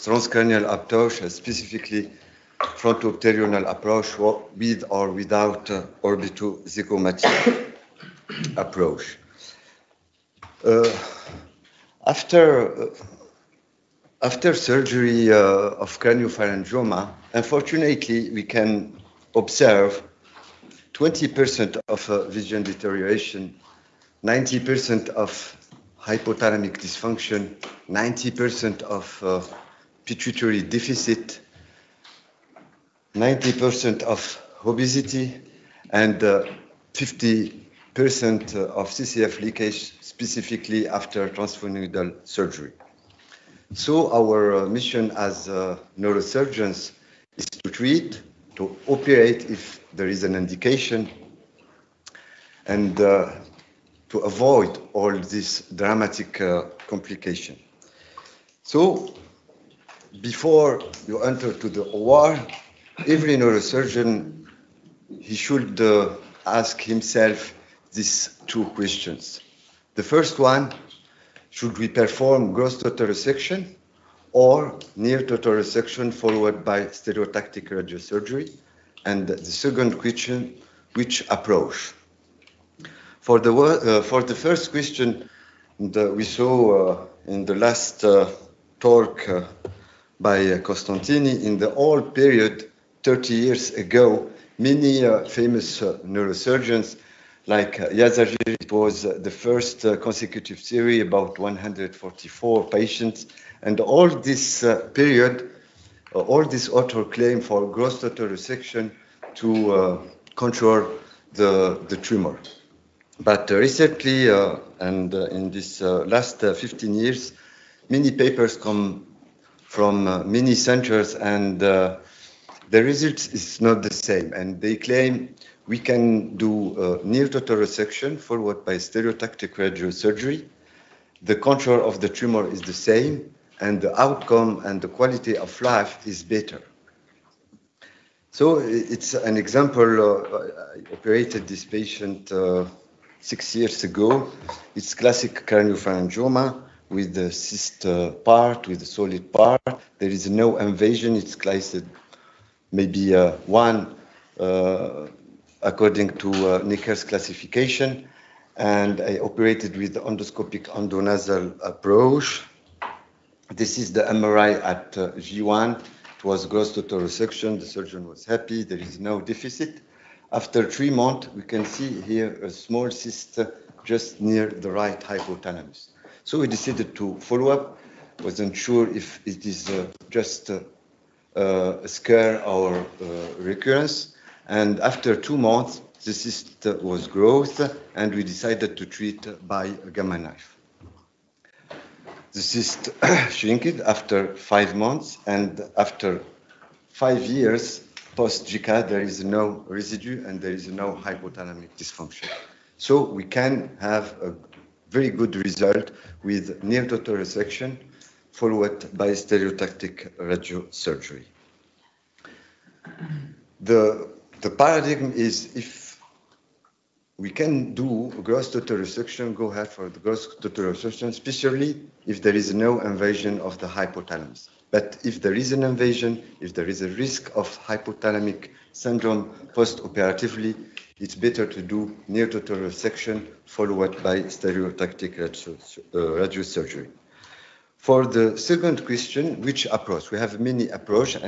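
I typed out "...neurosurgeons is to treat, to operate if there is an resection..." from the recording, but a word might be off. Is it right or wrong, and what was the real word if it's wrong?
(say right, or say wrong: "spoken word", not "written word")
wrong: "indication", not "resection".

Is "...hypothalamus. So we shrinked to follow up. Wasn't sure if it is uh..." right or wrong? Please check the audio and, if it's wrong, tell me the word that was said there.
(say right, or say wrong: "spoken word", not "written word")
wrong: "decided", not "shrinked".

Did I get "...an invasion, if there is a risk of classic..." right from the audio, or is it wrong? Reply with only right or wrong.
wrong.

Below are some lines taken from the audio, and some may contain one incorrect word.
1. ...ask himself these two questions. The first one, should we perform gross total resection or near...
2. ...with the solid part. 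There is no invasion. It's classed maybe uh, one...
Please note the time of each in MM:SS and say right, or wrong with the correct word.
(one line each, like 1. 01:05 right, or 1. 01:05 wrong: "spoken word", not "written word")
1. 01:06 right
2. 02:28 right.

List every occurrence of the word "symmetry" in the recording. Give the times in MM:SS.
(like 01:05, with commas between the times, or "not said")
not said.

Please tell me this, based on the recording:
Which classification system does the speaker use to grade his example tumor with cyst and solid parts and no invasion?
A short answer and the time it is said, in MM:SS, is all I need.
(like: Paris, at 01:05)
Nicker's classification, at 02:36.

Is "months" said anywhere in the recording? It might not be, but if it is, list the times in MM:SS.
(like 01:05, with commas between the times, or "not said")
02:50, 03:05, 03:14.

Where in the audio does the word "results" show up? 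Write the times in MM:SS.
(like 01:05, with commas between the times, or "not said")
02:02, 03:25.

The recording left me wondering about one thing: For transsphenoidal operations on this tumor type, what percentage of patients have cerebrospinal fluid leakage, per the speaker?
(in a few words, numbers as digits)
50%.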